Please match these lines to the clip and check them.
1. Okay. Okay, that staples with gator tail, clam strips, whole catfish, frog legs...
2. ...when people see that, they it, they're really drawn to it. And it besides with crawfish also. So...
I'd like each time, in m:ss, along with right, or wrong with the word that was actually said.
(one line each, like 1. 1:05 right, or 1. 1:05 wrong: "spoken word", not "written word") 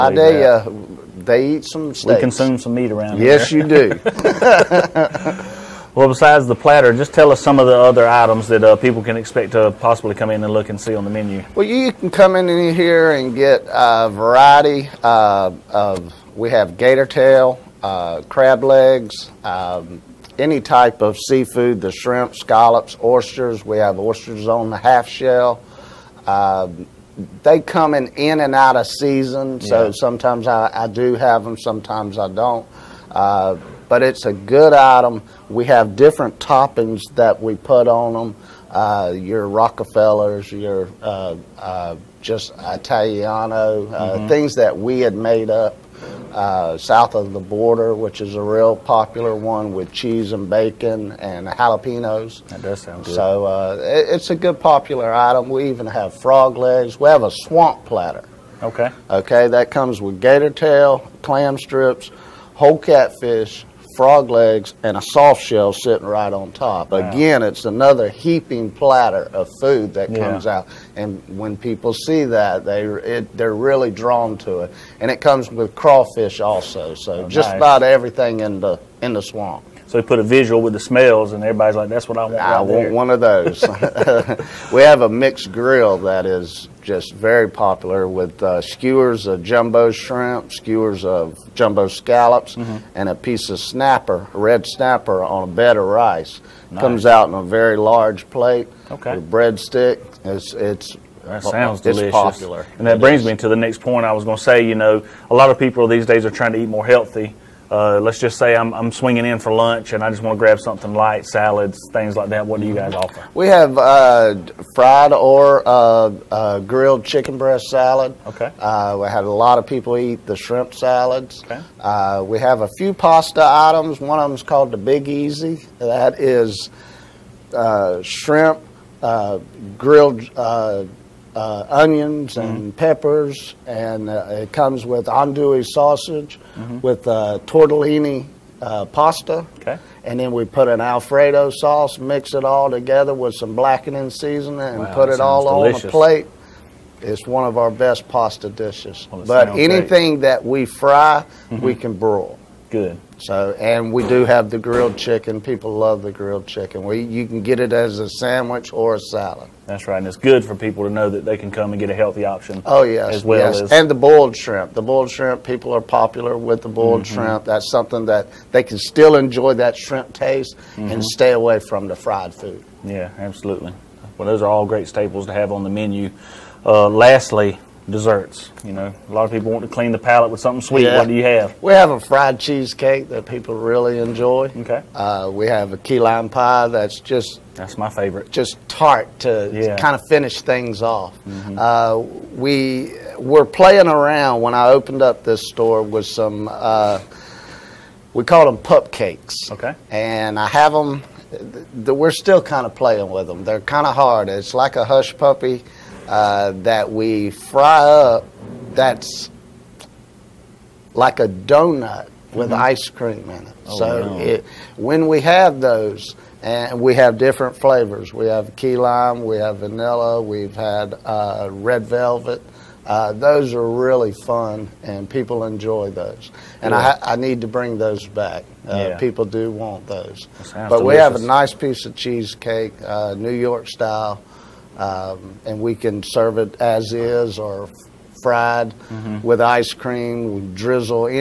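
1. 0:58 wrong: "comes", not "staples"
2. 1:11 wrong: "comes", not "besides".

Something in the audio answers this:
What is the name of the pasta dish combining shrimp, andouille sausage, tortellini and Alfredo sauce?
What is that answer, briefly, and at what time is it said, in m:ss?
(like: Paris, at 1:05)
The Big Easy, at 2:04.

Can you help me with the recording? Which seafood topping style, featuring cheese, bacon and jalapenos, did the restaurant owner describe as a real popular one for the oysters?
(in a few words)
South of the border.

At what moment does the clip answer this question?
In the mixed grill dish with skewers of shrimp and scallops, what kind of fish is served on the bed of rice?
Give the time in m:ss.
1:34.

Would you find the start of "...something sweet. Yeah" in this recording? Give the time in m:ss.
3:00.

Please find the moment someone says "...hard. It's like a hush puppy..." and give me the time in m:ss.
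3:23.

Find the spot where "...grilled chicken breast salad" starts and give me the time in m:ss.
1:56.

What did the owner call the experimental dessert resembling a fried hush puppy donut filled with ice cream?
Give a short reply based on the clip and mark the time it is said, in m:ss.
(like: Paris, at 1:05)
Pup cakes, at 3:18.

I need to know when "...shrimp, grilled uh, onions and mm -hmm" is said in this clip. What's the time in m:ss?
2:08.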